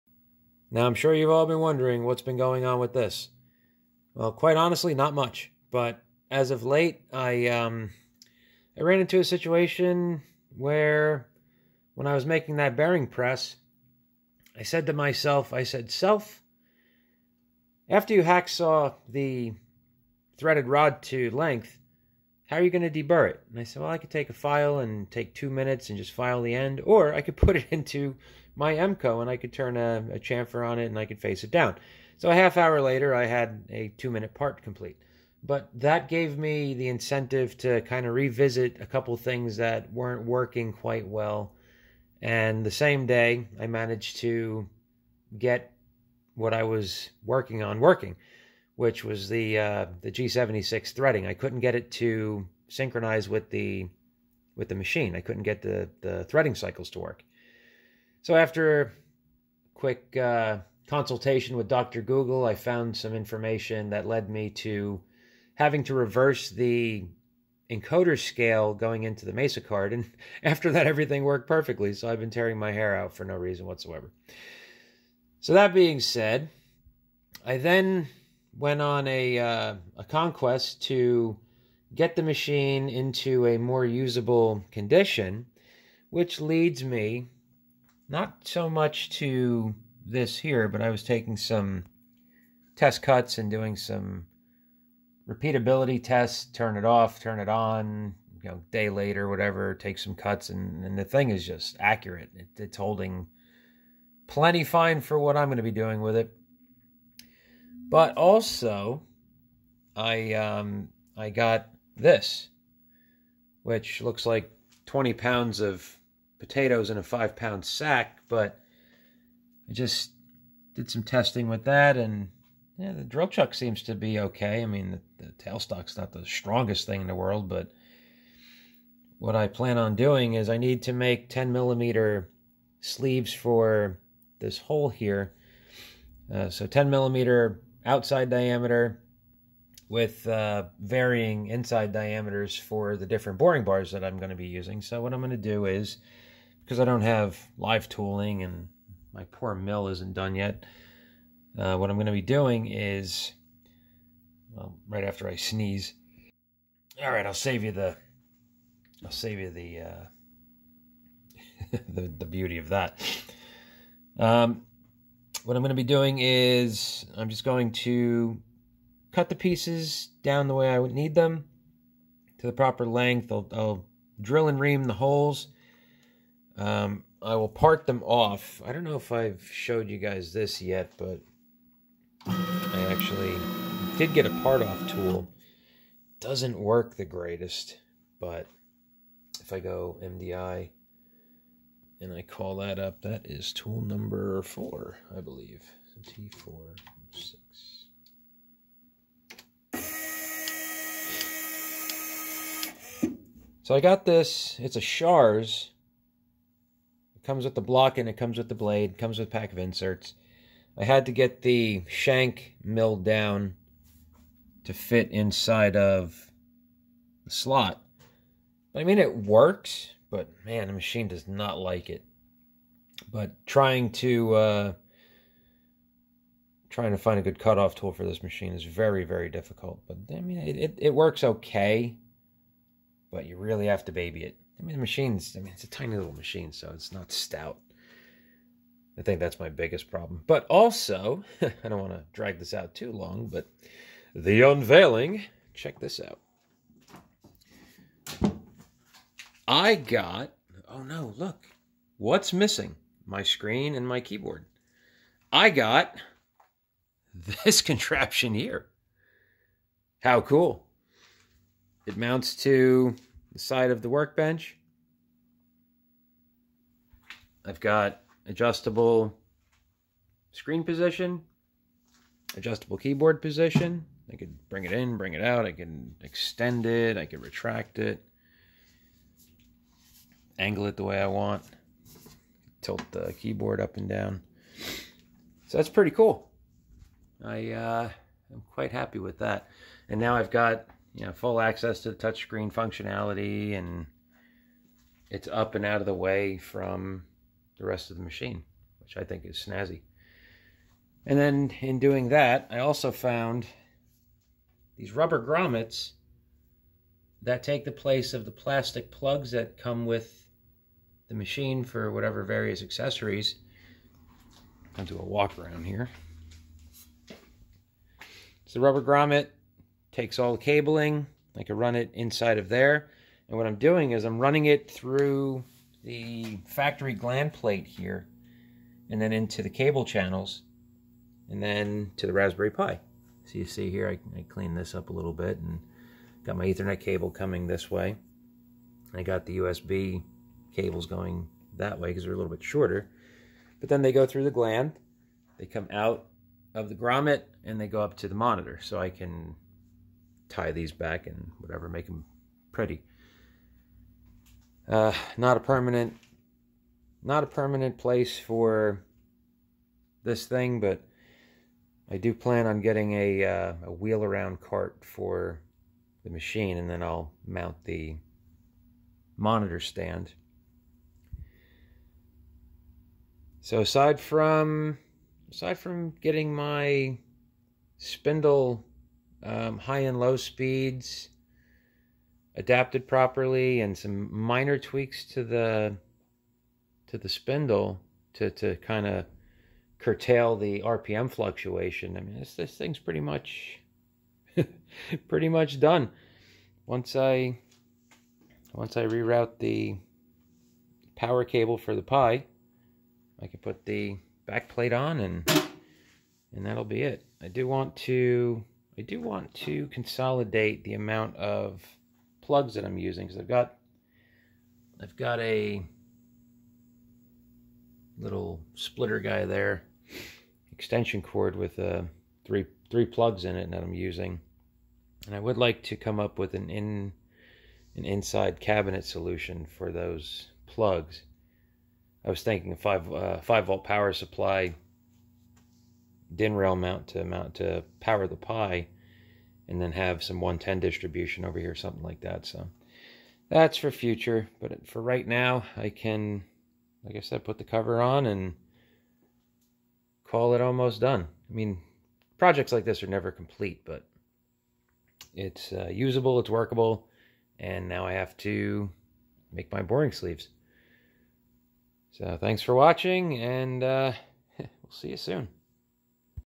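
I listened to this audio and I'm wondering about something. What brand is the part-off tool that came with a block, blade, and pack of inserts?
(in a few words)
Shars.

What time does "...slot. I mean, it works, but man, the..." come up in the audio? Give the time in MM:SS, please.
03:37.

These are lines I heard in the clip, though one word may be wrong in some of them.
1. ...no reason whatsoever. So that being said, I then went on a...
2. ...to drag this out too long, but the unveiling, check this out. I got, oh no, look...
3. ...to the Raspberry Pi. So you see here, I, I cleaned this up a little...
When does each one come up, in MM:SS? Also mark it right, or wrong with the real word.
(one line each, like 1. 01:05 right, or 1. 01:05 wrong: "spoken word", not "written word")
1. 01:13 right
2. 04:01 right
3. 05:31 right.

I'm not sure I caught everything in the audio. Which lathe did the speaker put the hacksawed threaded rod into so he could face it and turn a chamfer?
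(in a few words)
Emco.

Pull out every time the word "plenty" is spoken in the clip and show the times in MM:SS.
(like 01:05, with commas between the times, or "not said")
01:44.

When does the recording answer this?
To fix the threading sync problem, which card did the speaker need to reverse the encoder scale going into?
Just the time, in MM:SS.
01:09.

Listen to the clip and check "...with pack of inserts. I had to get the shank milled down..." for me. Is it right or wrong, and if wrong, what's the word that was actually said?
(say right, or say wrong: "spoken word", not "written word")
right.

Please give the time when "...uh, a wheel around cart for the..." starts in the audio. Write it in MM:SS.
06:03.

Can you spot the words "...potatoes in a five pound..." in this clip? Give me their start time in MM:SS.
01:56.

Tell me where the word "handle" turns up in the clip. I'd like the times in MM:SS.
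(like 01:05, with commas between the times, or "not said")
not said.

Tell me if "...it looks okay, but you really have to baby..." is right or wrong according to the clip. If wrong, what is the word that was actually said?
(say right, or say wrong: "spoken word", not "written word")
wrong: "works", not "looks".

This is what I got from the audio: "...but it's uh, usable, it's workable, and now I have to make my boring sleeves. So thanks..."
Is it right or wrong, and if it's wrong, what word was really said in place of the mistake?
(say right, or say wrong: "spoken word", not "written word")
right.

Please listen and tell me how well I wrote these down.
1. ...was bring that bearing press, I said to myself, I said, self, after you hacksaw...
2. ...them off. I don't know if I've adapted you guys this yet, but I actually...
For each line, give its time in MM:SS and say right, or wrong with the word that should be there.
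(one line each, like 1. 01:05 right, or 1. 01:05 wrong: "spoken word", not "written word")
1. 00:12 wrong: "making", not "bring"
2. 02:57 wrong: "showed", not "adapted".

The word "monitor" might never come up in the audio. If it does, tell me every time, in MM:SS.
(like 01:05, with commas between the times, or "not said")
05:48, 06:09.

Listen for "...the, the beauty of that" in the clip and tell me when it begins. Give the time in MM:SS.
02:41.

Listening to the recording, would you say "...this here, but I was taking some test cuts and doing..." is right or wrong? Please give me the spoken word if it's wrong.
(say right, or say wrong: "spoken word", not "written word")
right.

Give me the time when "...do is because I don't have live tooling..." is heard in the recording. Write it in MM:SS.
02:25.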